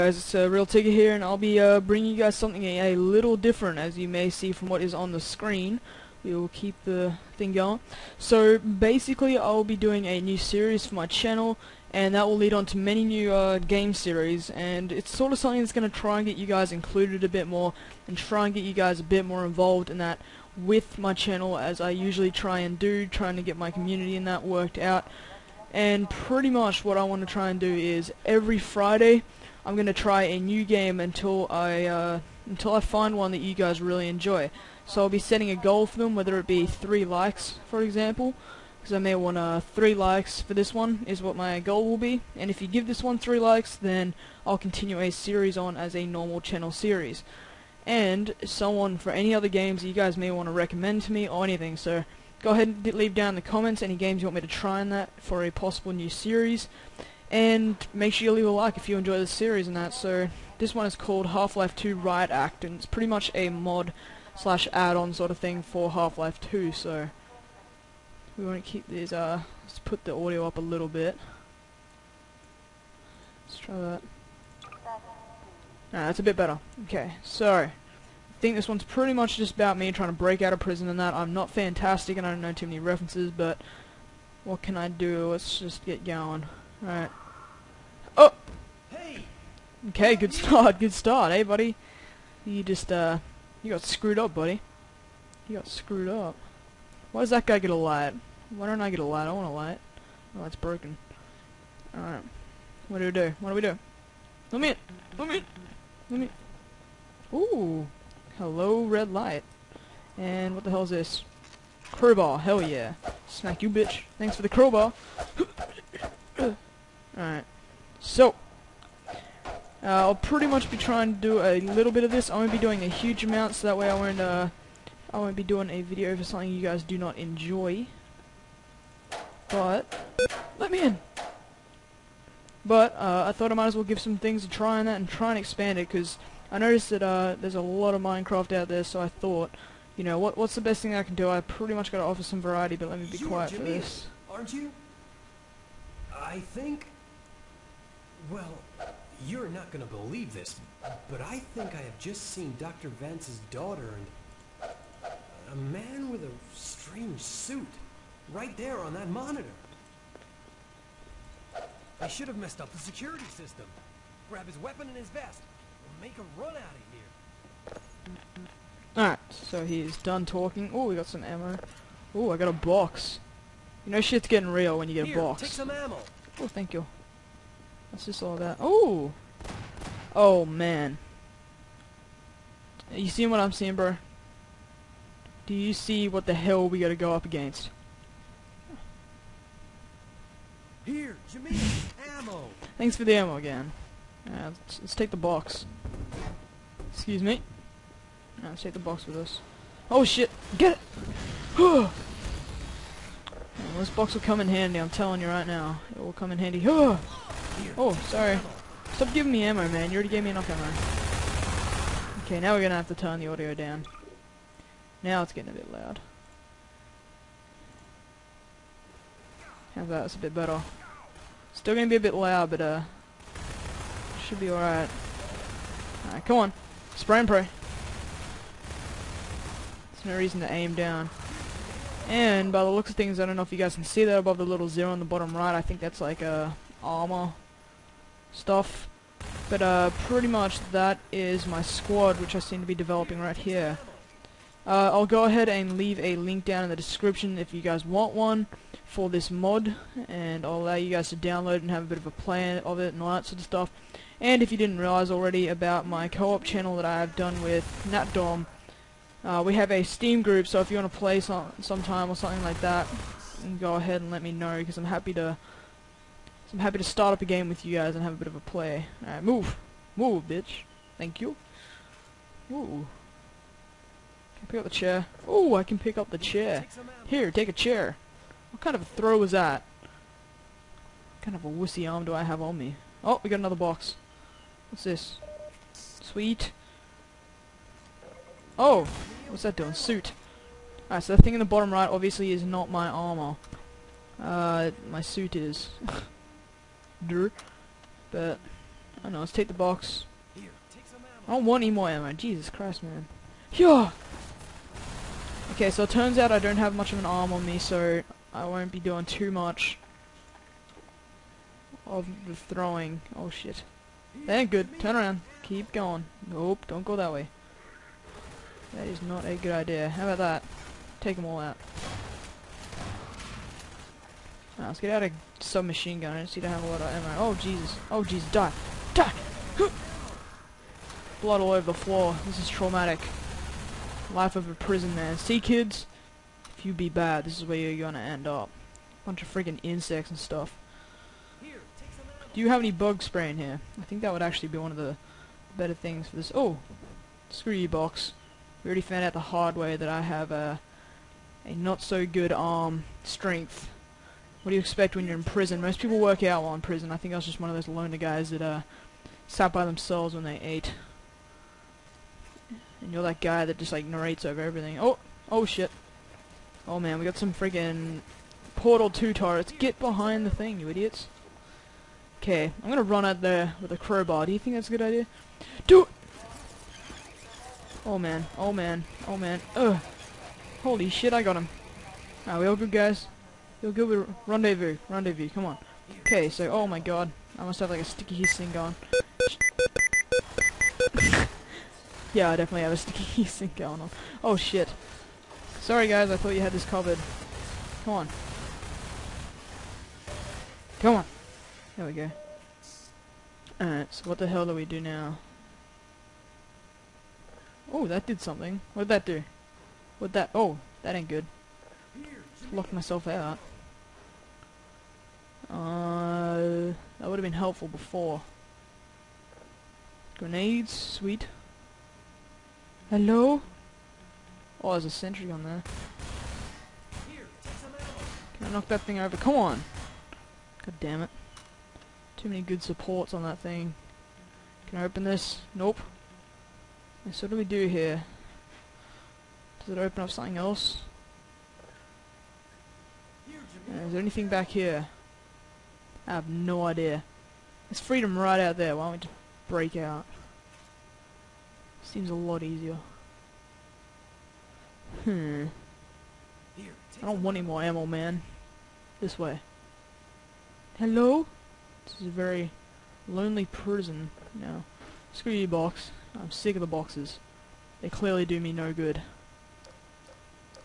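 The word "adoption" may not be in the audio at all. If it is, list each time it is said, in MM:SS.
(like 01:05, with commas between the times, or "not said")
not said.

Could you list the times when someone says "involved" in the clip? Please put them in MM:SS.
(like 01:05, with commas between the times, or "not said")
00:19.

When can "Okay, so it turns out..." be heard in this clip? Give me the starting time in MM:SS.
05:05.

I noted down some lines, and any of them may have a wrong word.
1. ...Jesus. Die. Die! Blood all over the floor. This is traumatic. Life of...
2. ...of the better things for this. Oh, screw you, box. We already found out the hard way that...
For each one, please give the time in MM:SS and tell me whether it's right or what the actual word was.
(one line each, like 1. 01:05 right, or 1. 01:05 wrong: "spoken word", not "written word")
1. 05:28 right
2. 05:44 right.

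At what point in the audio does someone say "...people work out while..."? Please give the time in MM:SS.
05:55.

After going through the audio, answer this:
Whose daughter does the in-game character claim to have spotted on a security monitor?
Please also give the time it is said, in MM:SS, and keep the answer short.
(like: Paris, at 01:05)
Dr. Vance's, at 02:32.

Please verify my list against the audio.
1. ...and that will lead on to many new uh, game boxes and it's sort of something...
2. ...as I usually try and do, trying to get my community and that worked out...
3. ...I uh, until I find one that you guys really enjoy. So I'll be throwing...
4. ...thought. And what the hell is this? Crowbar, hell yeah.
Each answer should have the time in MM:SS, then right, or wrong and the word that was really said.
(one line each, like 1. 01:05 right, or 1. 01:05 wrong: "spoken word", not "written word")
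1. 00:11 wrong: "series", not "boxes"
2. 00:21 right
3. 00:31 wrong: "setting", not "throwing"
4. 01:49 wrong: "light", not "thought".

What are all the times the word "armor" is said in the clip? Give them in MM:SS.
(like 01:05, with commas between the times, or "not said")
03:56, 04:52.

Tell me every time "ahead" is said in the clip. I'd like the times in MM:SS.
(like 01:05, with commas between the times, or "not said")
00:52, 04:05, 04:23.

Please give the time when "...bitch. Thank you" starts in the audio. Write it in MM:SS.
04:30.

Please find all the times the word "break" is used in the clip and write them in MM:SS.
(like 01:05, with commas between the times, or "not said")
01:20, 07:29.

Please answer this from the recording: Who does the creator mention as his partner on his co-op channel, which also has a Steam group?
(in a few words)
NatDom.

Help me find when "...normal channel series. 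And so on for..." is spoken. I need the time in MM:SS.
00:46.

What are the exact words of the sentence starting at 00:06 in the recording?
We will keep the thing going.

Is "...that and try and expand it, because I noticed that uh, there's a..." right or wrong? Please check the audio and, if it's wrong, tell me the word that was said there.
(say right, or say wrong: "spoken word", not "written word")
right.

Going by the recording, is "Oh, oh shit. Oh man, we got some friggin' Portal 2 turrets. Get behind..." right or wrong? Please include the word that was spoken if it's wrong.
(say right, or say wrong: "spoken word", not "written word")
right.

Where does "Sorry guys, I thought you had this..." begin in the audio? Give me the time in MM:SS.
06:35.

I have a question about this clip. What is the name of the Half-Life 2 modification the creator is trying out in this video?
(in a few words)
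Half-Life 2 Riot Act.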